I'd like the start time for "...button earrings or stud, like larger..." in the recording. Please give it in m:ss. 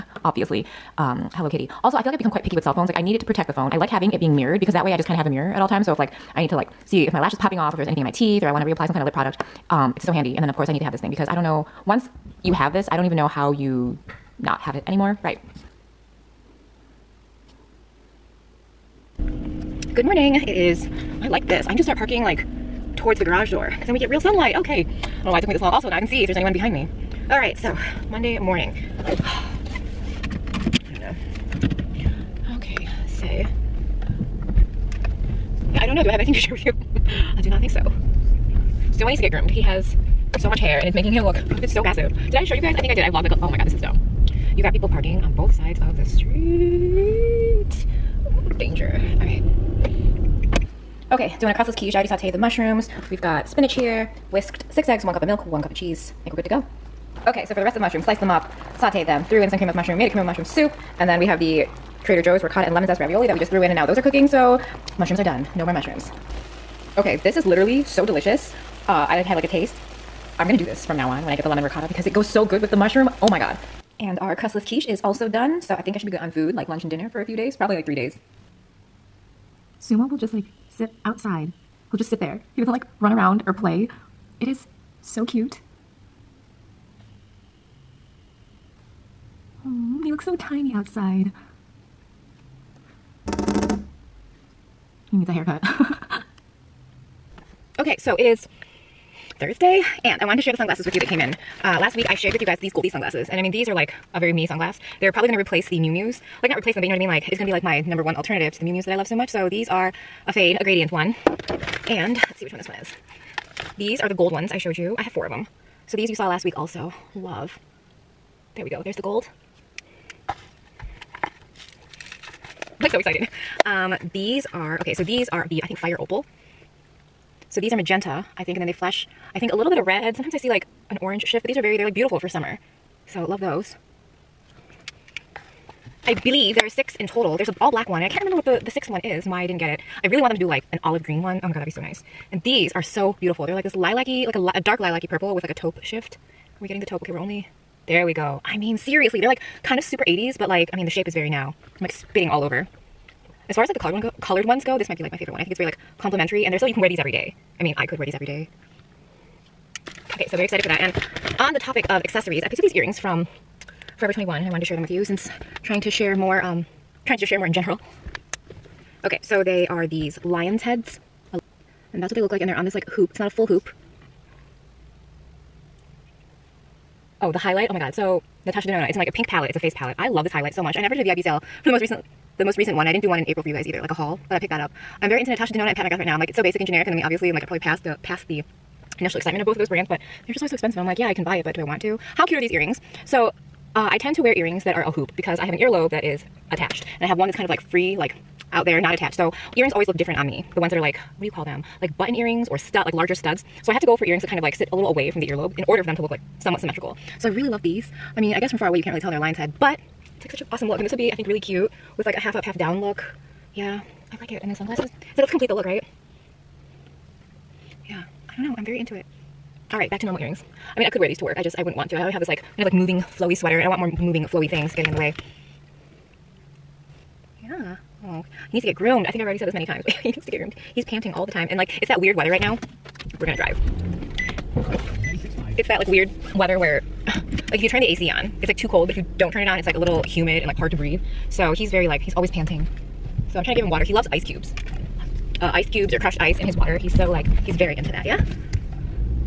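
3:21.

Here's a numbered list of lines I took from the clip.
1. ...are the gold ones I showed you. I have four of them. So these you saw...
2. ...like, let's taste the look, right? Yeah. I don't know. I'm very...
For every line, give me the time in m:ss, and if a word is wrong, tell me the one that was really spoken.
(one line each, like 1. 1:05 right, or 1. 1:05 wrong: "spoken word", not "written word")
1. 1:53 right
2. 3:35 wrong: "complete", not "taste".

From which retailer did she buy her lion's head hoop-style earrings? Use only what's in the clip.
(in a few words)
Forever 21.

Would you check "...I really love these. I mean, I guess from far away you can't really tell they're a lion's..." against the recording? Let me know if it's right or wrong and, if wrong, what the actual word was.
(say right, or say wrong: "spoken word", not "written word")
right.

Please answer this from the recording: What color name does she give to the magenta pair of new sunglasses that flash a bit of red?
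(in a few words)
Fire Opal.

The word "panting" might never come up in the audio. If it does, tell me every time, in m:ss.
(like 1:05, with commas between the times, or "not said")
3:50, 4:02.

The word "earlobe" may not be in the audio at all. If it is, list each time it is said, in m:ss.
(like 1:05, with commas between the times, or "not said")
3:15, 3:25.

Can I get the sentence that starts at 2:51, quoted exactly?
And that's what they look like, and they're on this like hoop.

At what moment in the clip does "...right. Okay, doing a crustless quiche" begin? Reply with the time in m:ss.
0:49.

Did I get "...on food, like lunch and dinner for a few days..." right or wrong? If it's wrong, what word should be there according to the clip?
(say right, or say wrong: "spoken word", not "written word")
right.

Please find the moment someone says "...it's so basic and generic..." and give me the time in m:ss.
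3:06.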